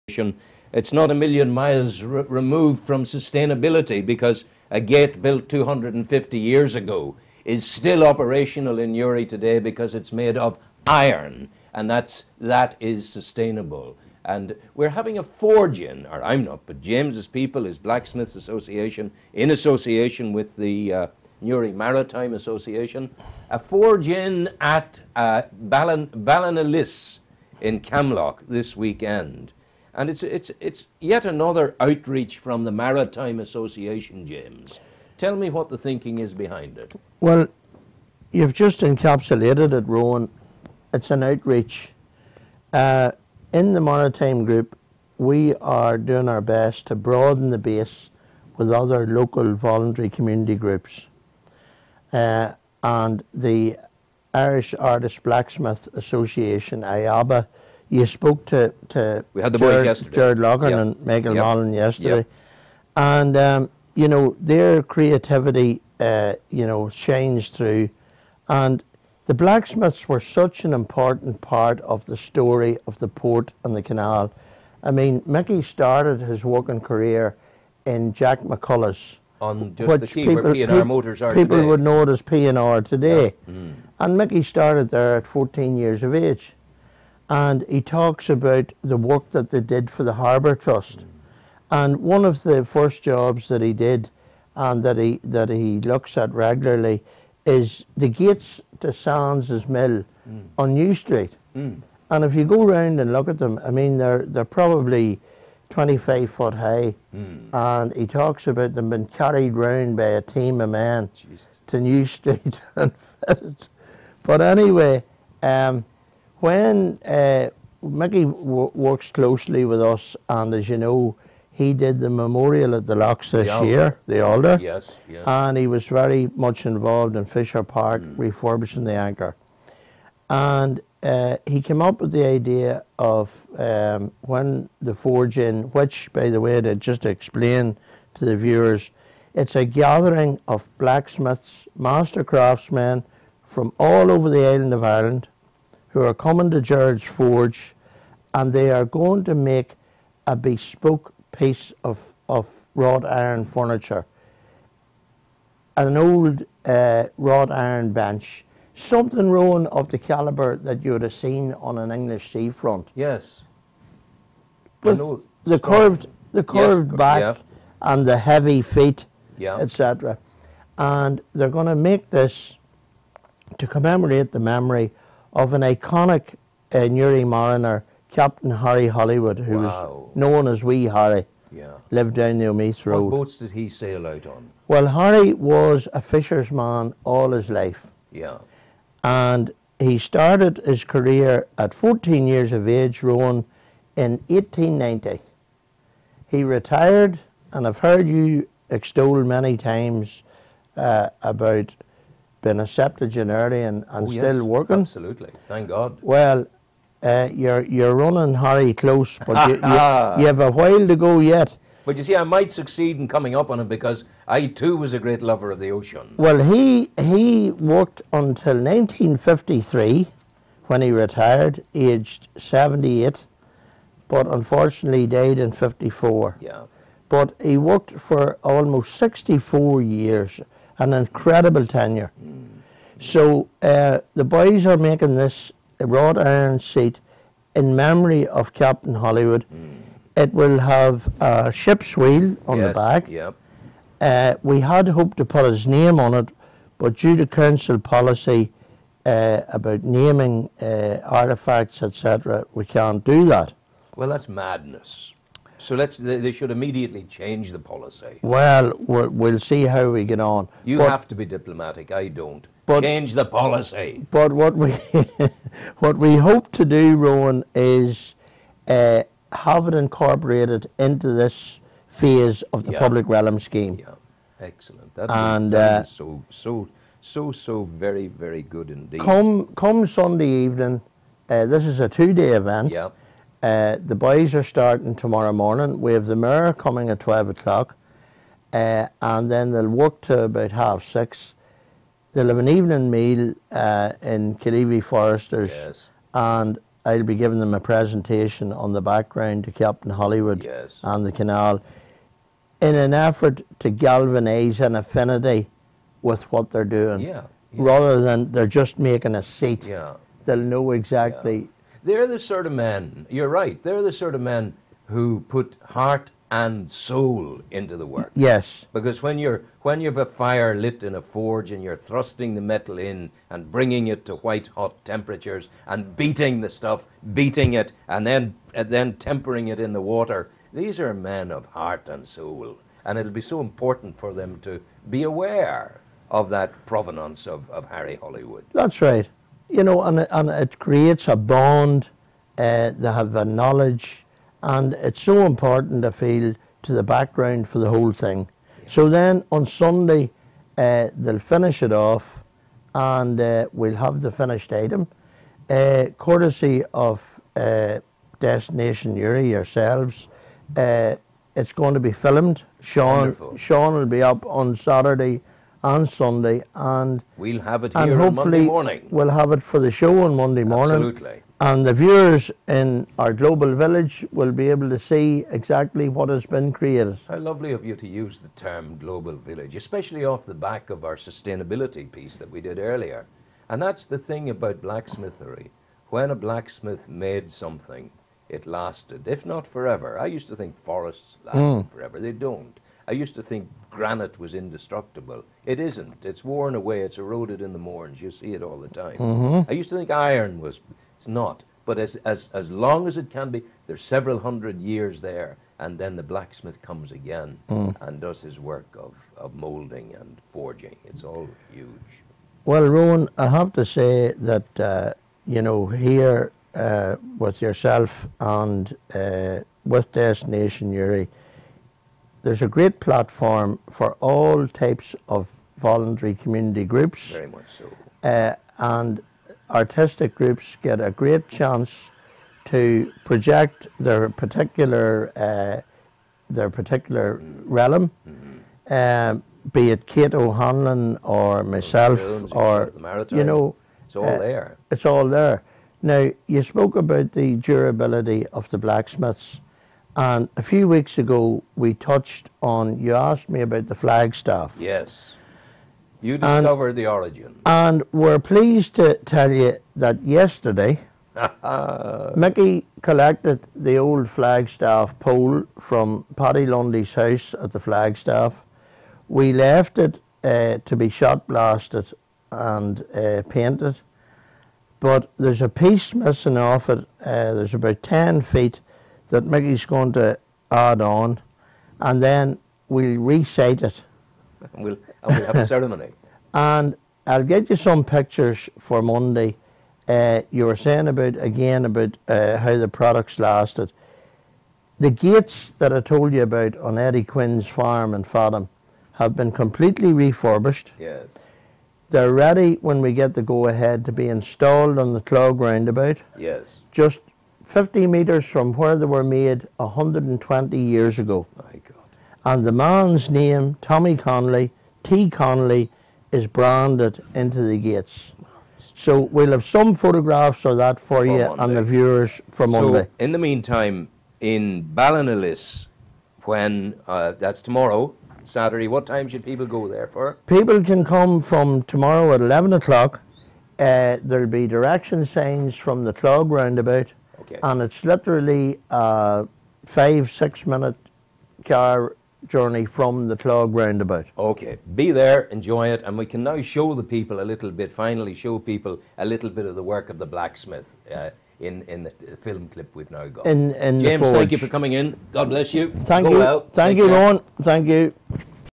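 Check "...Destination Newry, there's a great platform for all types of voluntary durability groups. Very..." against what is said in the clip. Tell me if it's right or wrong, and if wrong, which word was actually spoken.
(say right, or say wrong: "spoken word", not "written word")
wrong: "community", not "durability".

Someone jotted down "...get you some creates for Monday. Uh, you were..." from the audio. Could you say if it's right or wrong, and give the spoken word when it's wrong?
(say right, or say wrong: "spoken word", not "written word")
wrong: "pictures", not "creates".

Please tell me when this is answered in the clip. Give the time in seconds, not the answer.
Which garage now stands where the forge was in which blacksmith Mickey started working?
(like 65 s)
80 s.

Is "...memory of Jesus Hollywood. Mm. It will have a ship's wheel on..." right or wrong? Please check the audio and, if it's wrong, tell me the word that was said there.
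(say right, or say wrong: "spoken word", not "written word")
wrong: "Captain", not "Jesus".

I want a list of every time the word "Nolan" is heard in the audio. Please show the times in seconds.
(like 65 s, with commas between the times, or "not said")
61 s.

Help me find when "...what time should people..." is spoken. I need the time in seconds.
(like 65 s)
528 s.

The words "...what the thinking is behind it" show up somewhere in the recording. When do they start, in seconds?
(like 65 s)
35 s.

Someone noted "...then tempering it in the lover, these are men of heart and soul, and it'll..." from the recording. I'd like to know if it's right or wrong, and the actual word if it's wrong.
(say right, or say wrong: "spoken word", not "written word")
wrong: "water", not "lover".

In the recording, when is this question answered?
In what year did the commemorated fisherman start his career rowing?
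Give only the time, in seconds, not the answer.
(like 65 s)
194 s.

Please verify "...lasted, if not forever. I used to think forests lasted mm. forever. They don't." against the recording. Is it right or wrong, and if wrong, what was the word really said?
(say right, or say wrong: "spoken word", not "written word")
right.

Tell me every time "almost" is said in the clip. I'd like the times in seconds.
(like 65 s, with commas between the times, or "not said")
228 s.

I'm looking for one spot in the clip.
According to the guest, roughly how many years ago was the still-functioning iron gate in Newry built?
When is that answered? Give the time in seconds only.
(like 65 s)
5 s.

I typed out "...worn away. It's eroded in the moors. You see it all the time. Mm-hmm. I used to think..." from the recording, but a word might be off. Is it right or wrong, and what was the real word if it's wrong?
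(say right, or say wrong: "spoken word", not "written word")
right.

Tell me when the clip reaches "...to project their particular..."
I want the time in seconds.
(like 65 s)
432 s.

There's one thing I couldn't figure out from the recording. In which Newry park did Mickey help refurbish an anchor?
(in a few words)
Fisher Park.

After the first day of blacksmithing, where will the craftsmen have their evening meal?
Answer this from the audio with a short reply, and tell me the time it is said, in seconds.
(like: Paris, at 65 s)
Killeavy Foresters, at 294 s.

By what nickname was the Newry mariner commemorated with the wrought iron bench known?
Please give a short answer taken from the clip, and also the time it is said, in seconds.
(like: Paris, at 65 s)
Wee Harry, at 180 s.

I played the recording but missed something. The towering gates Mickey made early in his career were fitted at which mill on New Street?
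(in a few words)
Sands' mill.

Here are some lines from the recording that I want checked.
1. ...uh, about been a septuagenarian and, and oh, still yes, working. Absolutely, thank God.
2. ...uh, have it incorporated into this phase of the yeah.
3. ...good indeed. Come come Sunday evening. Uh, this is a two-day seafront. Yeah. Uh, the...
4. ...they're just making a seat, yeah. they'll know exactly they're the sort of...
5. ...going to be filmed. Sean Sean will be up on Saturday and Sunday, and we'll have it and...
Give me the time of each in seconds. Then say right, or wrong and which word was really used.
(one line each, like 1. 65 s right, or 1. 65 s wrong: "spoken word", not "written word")
1. 200 s right
2. 268 s right
3. 278 s wrong: "event", not "seafront"
4. 308 s right
5. 361 s right.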